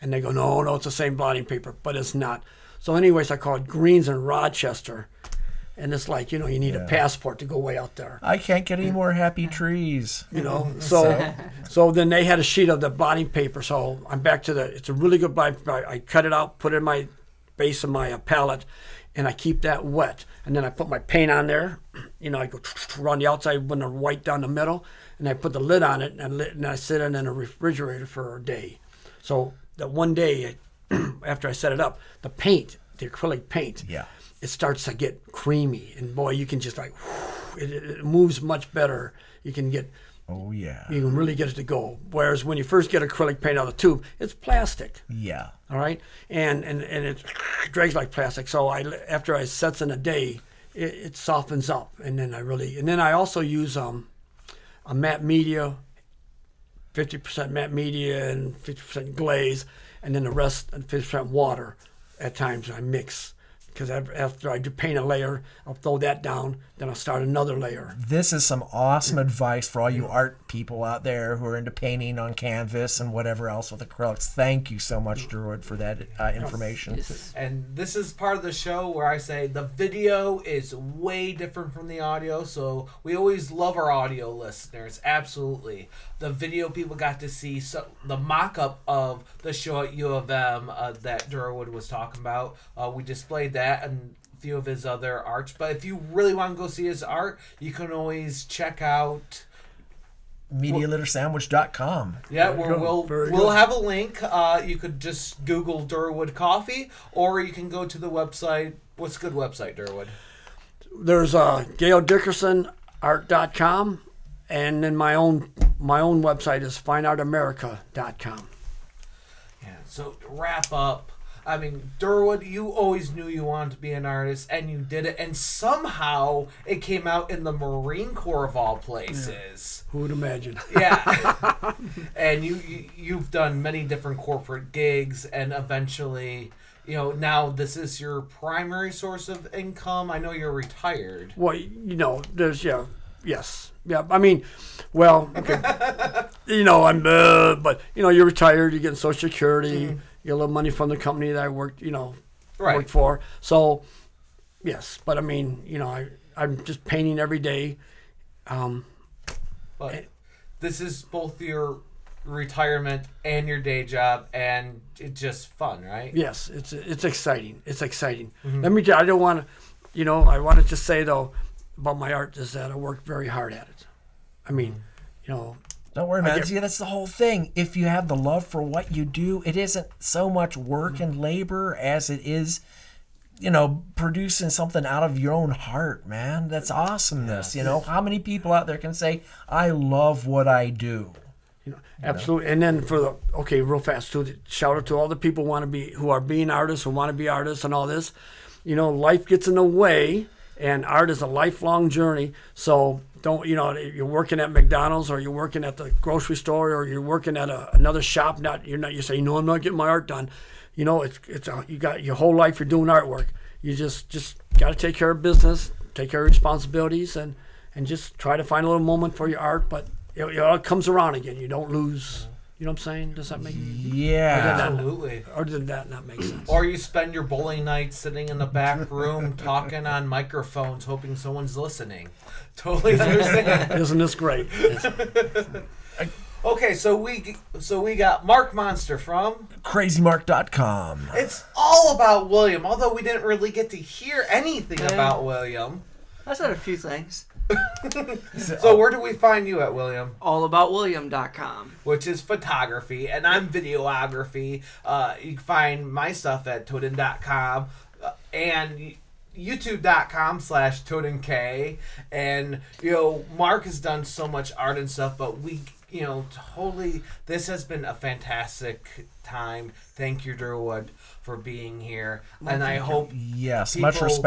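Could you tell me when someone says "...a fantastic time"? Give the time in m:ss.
4:27.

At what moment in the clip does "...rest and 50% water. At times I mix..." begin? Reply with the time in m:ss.
1:00.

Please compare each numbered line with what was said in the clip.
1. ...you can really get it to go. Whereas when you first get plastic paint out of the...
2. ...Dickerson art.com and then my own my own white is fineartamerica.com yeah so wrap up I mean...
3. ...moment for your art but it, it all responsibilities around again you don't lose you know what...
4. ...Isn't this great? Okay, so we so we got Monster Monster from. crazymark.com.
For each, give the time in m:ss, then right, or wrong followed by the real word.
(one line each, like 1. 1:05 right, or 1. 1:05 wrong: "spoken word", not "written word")
1. 0:40 wrong: "acrylic", not "plastic"
2. 1:52 wrong: "website", not "white"
3. 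3:38 wrong: "comes", not "responsibilities"
4. 3:53 wrong: "Mark", not "Monster".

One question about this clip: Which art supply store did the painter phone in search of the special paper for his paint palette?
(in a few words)
Greens.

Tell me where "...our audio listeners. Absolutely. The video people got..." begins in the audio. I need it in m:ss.
1:23.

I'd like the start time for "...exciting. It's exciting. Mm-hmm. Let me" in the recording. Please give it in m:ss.
2:47.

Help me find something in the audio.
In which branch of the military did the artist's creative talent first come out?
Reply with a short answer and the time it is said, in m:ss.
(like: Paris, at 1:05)
Marine Corps, at 2:07.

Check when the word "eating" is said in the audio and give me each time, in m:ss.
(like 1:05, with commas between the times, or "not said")
not said.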